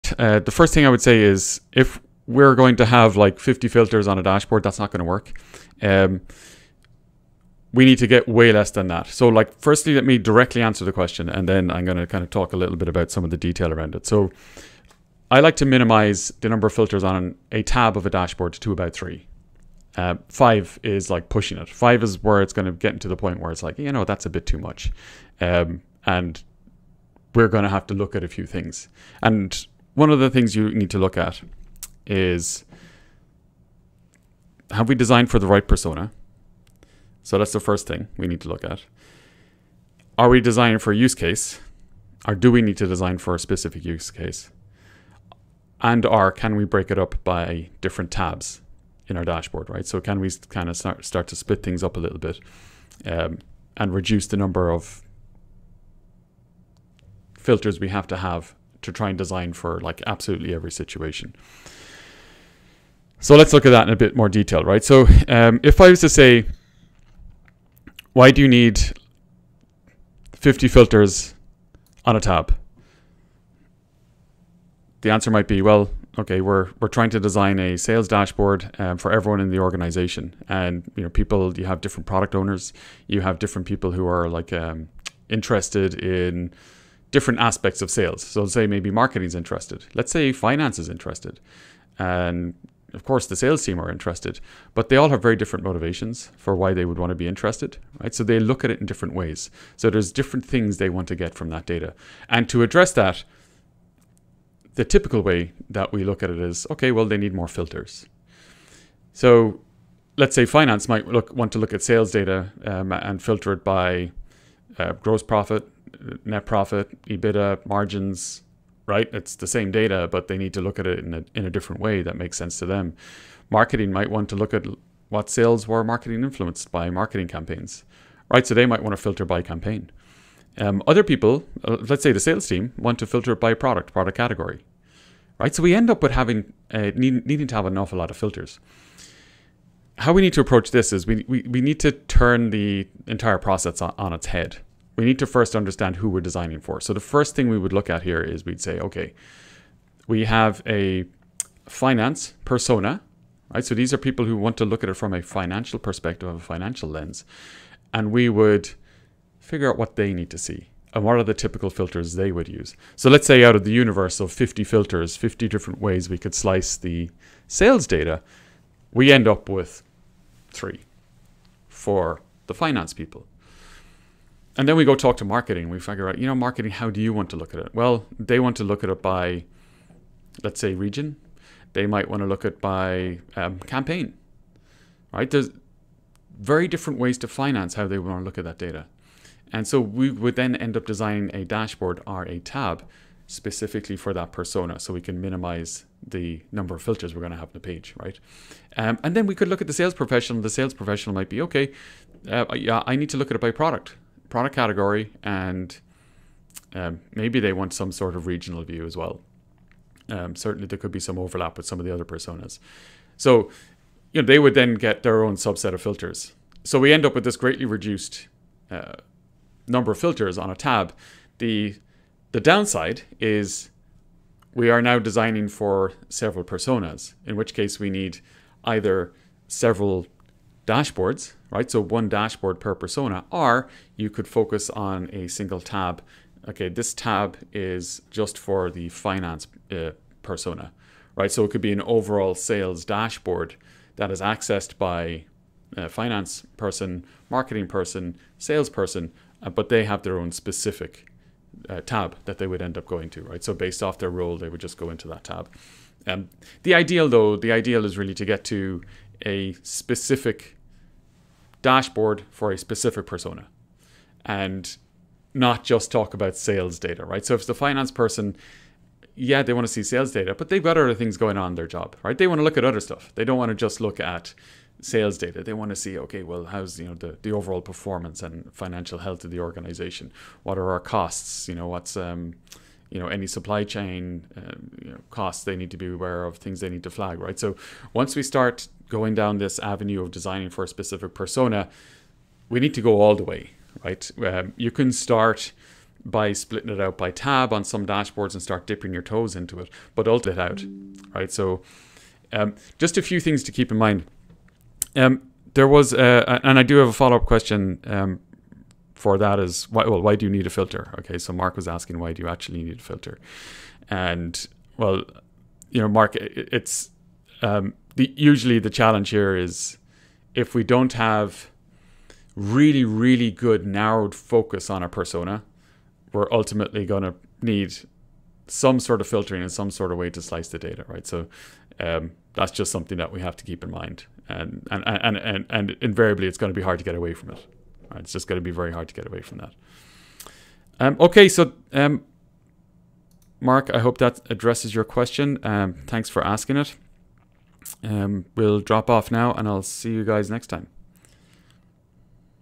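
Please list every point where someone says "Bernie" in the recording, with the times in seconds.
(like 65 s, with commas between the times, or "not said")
not said.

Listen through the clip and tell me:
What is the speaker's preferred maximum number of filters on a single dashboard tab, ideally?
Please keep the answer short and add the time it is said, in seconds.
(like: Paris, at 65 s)
3, at 18 s.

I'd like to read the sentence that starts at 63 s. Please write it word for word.
So let's look at that in a bit more detail, right?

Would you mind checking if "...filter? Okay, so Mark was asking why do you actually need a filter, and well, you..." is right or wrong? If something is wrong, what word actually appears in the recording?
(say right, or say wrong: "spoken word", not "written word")
right.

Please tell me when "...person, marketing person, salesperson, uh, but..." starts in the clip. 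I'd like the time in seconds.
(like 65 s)
246 s.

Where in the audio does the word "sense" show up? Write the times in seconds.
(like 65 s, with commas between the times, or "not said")
122 s.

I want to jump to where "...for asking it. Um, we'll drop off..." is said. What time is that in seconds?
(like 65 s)
346 s.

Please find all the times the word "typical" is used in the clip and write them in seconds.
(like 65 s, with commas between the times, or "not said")
104 s, 161 s.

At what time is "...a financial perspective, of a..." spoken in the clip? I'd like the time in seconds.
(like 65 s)
155 s.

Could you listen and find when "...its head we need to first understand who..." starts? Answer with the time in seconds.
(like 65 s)
144 s.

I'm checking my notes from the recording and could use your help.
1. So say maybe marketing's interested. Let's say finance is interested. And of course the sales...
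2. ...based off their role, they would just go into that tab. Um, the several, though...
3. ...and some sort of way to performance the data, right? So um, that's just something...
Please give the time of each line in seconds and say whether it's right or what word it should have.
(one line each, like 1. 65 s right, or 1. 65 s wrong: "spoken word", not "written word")
1. 88 s right
2. 253 s wrong: "ideal", not "several"
3. 329 s wrong: "slice", not "performance".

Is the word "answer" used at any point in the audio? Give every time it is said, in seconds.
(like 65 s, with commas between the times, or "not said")
10 s, 75 s.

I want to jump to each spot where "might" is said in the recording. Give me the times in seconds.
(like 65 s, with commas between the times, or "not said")
75 s, 110 s, 123 s, 128 s, 181 s, 201 s.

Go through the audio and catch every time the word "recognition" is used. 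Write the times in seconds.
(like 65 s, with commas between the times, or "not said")
not said.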